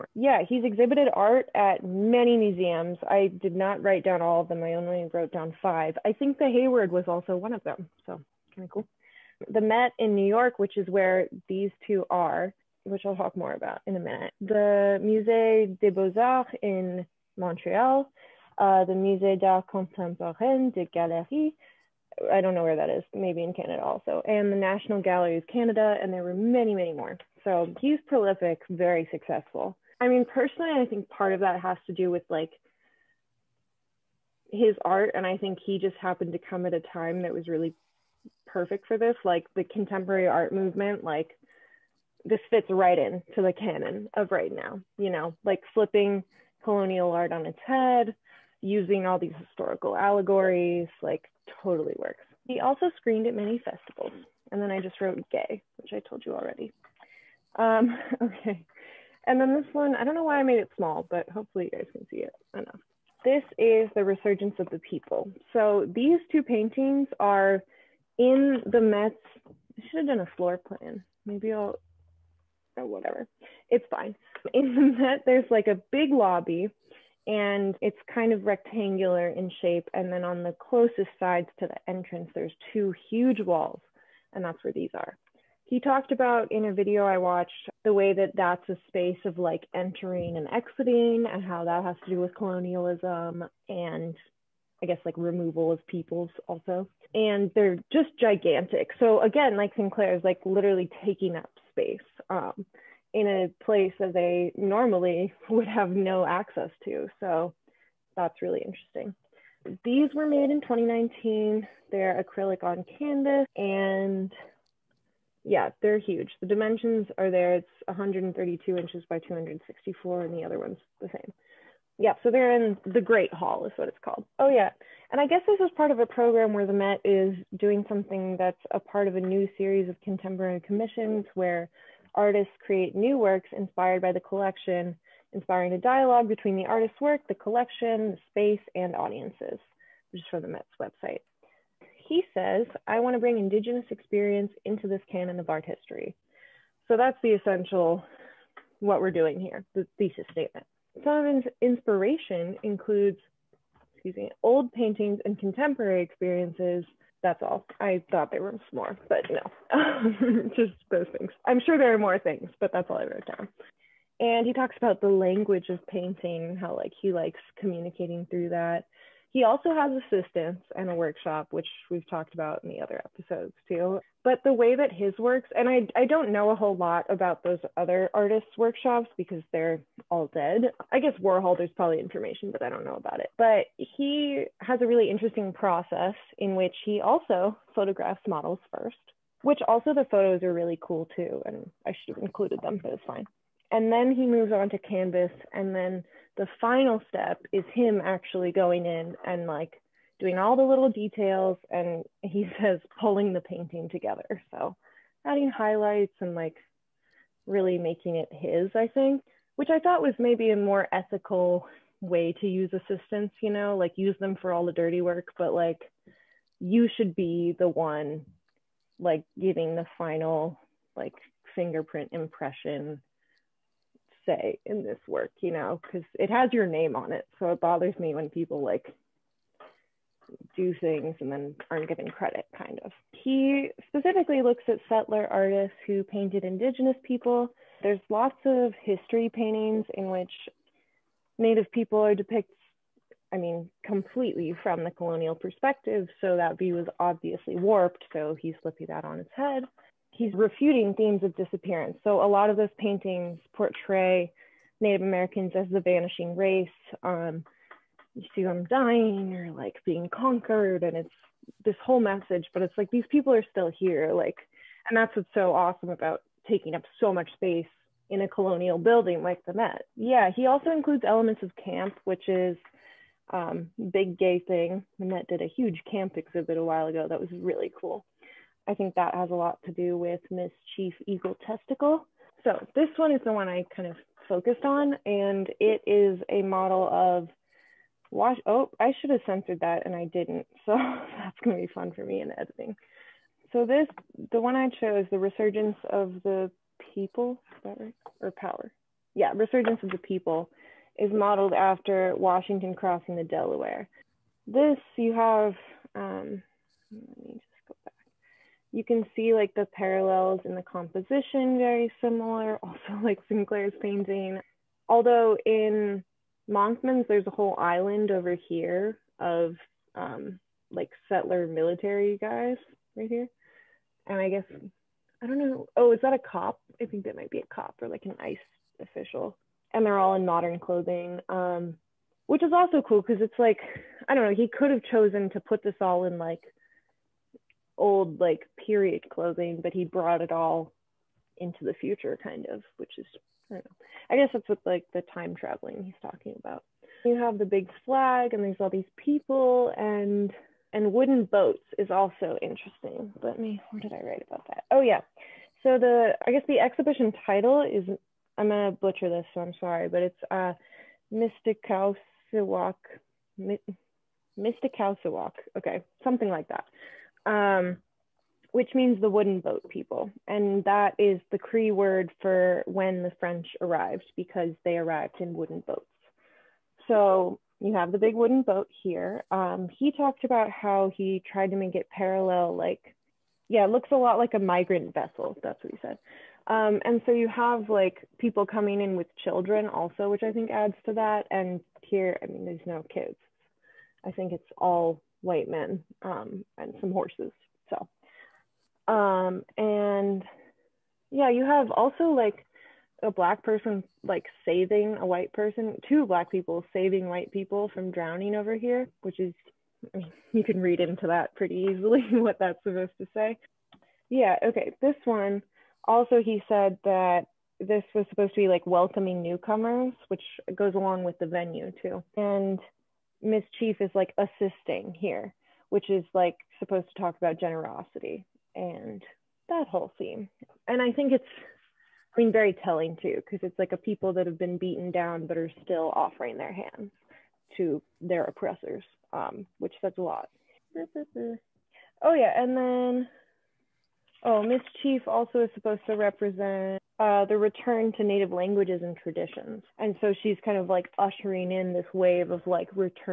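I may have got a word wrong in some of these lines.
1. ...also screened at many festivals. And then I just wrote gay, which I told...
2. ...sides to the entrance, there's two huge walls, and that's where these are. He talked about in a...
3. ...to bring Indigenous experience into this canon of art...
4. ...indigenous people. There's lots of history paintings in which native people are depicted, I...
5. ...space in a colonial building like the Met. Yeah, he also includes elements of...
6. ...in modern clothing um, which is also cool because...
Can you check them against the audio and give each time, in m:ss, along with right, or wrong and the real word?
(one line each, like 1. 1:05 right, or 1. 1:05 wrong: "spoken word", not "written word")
1. 0:52 right
2. 1:21 right
3. 2:23 right
4. 3:56 right
5. 4:27 right
6. 5:30 right.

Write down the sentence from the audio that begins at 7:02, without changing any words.
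And Miss Chief is like assisting here, which is like supposed to talk about generosity and that whole theme.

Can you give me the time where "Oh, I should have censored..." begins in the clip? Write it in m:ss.
4:48.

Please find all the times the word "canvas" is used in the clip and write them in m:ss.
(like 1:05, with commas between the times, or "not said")
1:52, 3:14.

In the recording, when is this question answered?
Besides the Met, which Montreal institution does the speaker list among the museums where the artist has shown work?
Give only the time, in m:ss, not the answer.
0:15.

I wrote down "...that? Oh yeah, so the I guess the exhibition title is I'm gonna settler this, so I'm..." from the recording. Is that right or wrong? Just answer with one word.
wrong.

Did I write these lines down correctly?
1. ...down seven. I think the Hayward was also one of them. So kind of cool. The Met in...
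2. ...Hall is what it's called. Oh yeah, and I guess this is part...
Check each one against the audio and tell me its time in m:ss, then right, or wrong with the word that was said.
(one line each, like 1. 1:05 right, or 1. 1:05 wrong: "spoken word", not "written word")
1. 0:05 wrong: "five", not "seven"
2. 2:03 right.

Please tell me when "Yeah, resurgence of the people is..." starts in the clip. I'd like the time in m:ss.
4:59.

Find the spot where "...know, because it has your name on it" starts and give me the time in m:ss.
3:45.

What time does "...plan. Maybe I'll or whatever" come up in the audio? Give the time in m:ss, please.
1:10.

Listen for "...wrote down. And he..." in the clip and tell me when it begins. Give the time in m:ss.
2:43.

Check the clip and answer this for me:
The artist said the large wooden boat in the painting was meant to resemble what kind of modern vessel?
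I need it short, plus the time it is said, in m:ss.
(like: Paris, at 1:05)
a migrant vessel, at 6:24.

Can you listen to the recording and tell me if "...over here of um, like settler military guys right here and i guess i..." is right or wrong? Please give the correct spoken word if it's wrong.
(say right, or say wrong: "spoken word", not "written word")
right.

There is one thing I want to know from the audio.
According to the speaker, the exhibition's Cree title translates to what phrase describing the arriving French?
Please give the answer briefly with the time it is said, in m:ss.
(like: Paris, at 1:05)
the wooden boat people, at 6:08.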